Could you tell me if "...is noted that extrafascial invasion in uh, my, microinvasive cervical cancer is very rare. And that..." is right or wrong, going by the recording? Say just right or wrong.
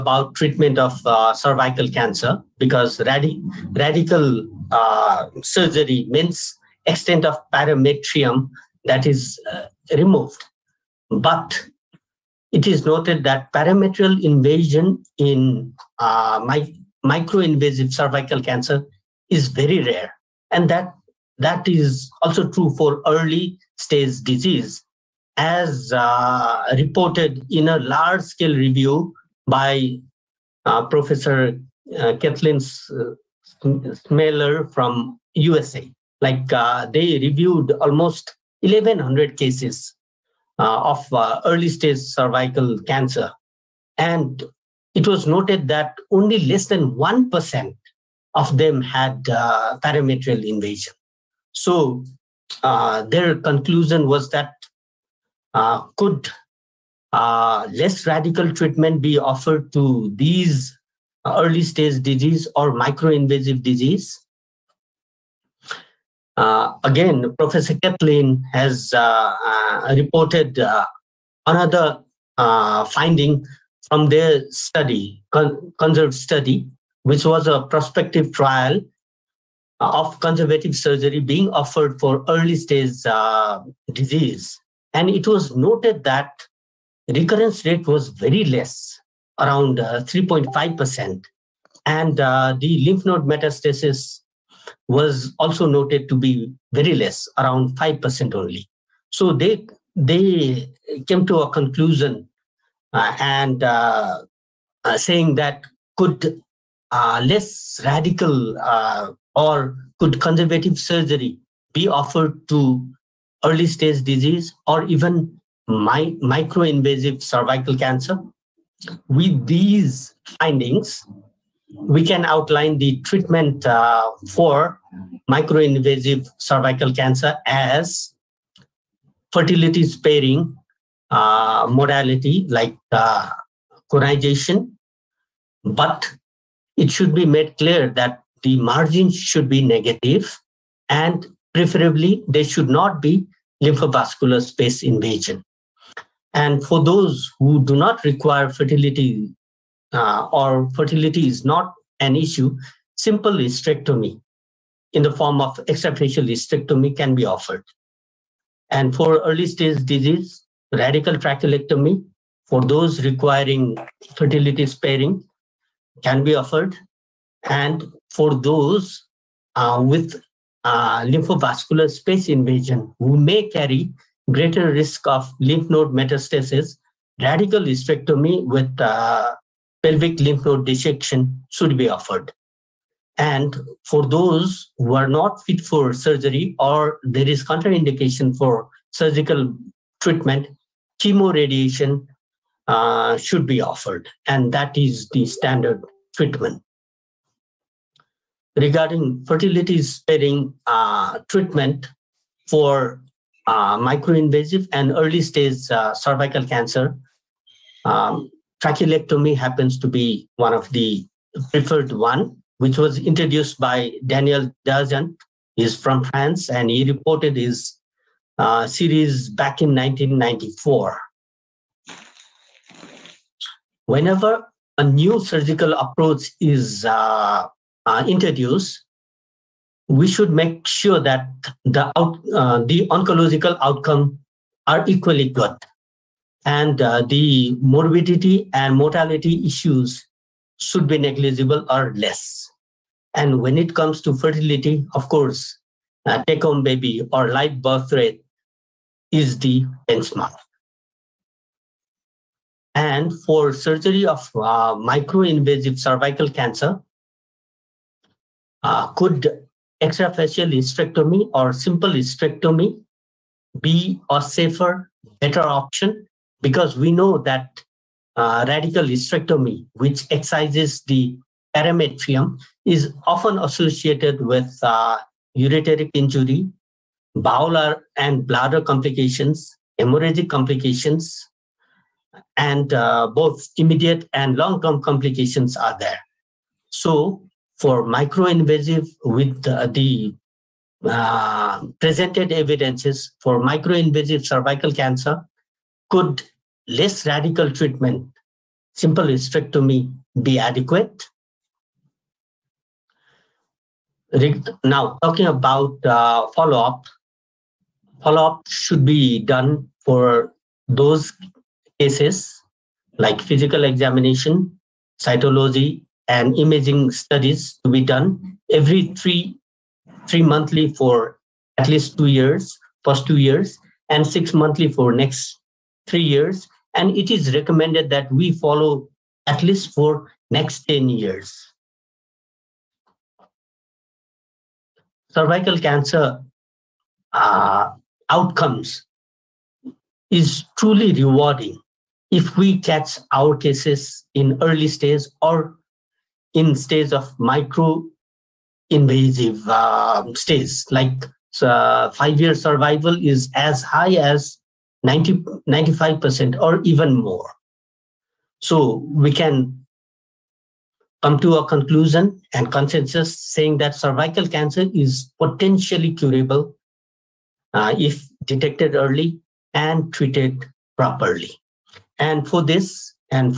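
wrong.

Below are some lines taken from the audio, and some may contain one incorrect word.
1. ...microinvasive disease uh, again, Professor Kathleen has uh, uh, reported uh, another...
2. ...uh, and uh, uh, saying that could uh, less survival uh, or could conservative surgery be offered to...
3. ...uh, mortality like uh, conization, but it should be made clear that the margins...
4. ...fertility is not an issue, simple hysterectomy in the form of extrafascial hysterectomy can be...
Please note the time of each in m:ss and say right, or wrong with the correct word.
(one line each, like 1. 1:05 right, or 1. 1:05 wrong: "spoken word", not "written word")
1. 1:02 right
2. 1:42 wrong: "radical", not "survival"
3. 2:11 wrong: "modality", not "mortality"
4. 2:30 right.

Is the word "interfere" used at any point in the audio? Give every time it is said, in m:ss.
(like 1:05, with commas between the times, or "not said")
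not said.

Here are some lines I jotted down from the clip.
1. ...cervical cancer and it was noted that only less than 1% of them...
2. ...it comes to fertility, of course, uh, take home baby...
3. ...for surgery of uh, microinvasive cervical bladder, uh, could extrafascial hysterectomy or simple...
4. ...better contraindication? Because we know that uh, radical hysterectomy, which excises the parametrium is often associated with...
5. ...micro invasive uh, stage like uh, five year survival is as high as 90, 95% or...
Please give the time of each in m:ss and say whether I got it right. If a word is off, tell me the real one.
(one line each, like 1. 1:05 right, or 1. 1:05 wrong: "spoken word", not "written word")
1. 0:41 right
2. 4:03 right
3. 4:13 wrong: "cancer", not "bladder"
4. 4:25 wrong: "option", not "contraindication"
5. 5:47 right.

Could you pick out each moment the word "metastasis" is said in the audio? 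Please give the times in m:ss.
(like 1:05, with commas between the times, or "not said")
1:33, 2:55.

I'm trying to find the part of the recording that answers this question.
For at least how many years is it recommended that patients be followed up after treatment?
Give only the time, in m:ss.
5:30.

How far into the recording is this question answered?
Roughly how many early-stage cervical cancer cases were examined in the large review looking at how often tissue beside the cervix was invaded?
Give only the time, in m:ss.
0:38.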